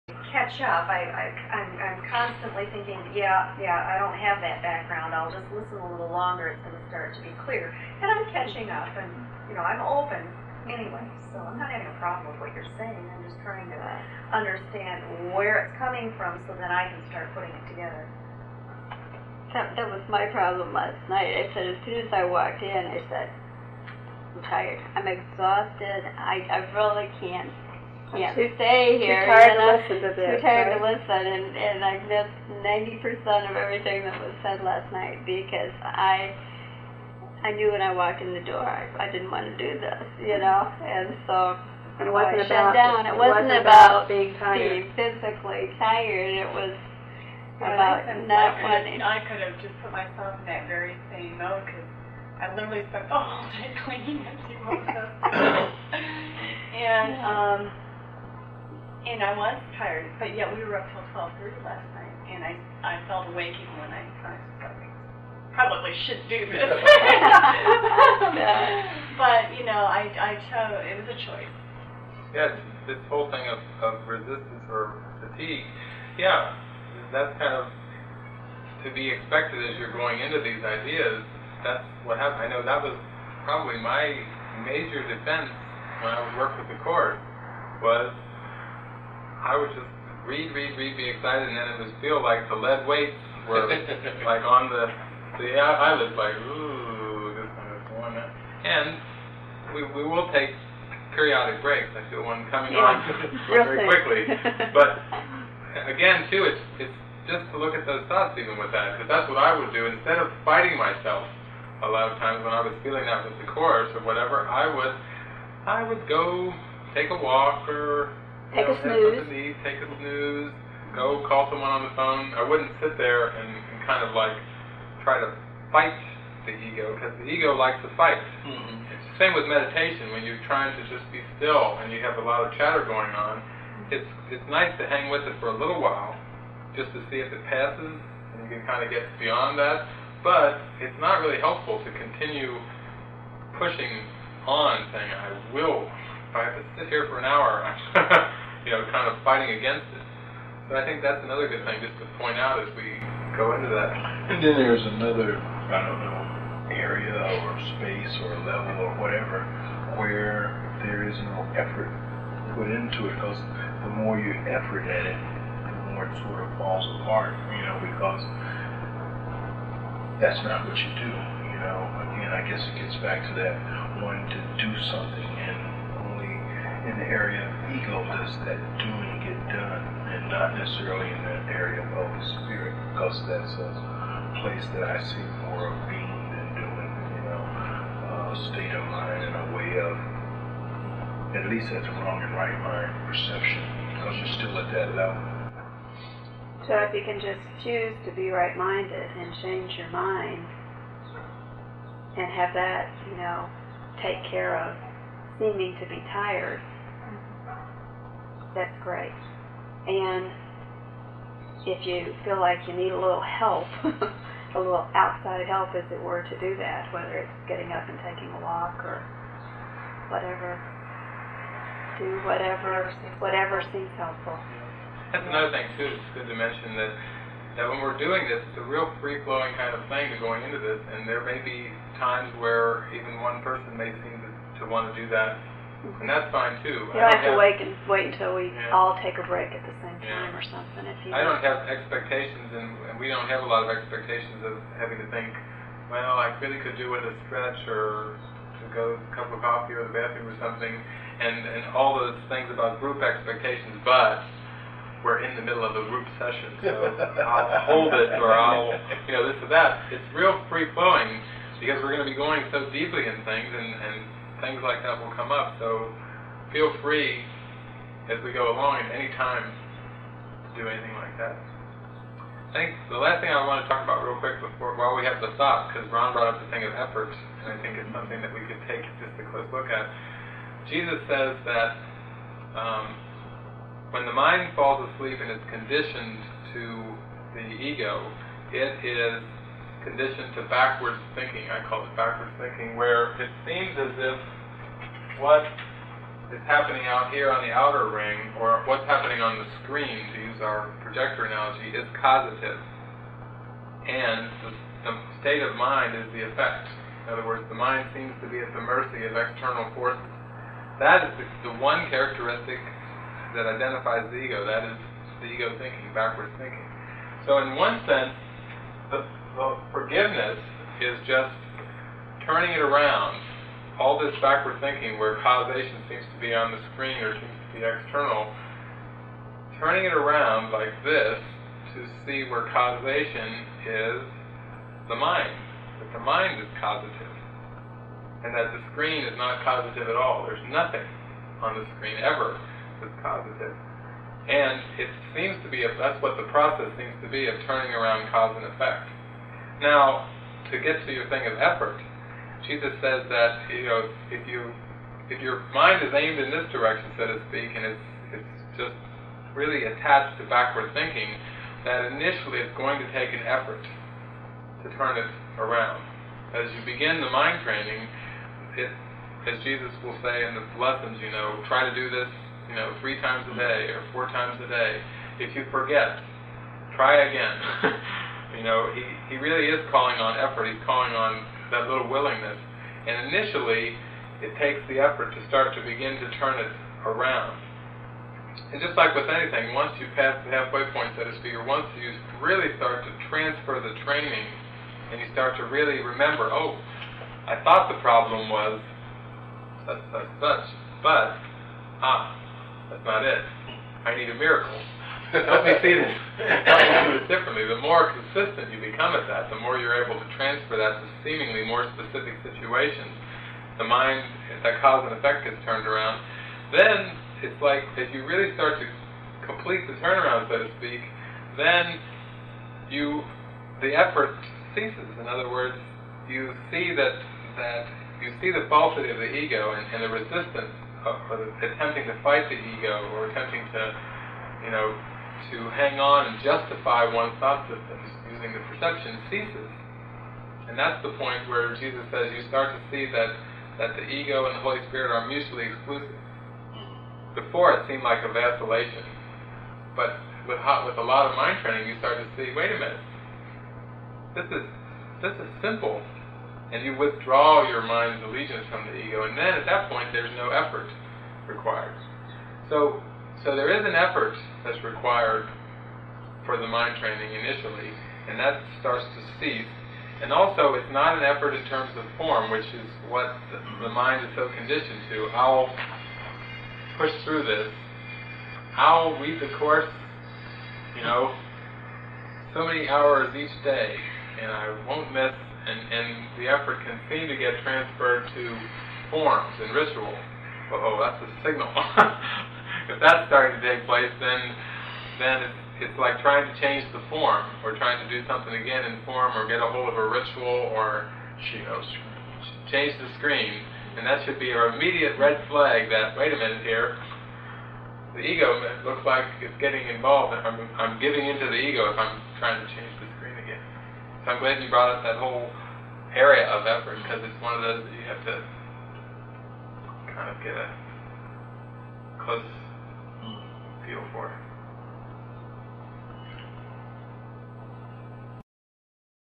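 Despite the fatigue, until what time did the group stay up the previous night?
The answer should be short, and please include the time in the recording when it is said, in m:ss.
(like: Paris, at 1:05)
12:30, at 1:01.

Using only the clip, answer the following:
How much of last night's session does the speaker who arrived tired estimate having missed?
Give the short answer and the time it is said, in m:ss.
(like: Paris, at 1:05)
90 percent, at 0:32.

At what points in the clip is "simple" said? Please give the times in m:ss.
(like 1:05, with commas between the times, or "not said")
7:35.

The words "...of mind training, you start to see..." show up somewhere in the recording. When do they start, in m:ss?
7:31.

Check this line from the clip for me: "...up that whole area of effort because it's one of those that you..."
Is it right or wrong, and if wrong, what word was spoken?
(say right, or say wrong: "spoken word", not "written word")
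right.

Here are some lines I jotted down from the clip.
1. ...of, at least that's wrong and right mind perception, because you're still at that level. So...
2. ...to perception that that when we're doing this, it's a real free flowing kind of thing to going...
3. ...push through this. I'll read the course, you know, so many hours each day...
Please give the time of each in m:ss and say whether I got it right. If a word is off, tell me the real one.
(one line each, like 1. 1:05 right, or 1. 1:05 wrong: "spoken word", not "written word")
1. 3:09 right
2. 3:46 wrong: "mention", not "perception"
3. 7:56 right.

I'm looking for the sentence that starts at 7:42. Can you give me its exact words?
So so there is an effort that's required for the mind training initially, and that starts to cease.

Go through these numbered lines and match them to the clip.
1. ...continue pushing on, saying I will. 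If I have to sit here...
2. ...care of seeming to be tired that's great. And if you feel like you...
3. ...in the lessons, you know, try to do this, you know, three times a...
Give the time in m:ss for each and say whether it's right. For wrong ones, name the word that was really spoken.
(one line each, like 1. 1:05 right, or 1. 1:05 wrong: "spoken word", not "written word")
1. 2:21 right
2. 3:24 right
3. 6:10 right.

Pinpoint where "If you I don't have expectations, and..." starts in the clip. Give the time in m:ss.
4:00.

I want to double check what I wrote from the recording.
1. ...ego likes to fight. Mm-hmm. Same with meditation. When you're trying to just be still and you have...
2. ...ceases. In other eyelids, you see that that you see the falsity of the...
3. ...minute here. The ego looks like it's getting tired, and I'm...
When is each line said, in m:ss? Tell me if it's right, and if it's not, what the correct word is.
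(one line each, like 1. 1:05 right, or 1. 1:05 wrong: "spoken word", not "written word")
1. 2:07 right
2. 7:04 wrong: "words", not "eyelids"
3. 8:26 wrong: "involved", not "tired".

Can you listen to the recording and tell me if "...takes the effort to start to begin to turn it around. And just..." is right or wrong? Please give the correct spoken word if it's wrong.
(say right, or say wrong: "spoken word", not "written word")
right.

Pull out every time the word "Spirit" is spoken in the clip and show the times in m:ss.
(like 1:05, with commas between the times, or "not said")
3:02, 7:24.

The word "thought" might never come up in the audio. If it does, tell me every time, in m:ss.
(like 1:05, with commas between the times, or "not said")
1:48, 4:35, 6:37, 7:17.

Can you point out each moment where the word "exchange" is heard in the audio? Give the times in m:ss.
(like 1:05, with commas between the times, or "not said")
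not said.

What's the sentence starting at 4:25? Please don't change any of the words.
So feel free as we go along at any time to do anything like that.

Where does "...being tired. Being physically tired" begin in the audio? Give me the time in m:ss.
0:44.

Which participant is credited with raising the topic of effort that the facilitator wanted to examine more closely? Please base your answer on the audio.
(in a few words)
Ron.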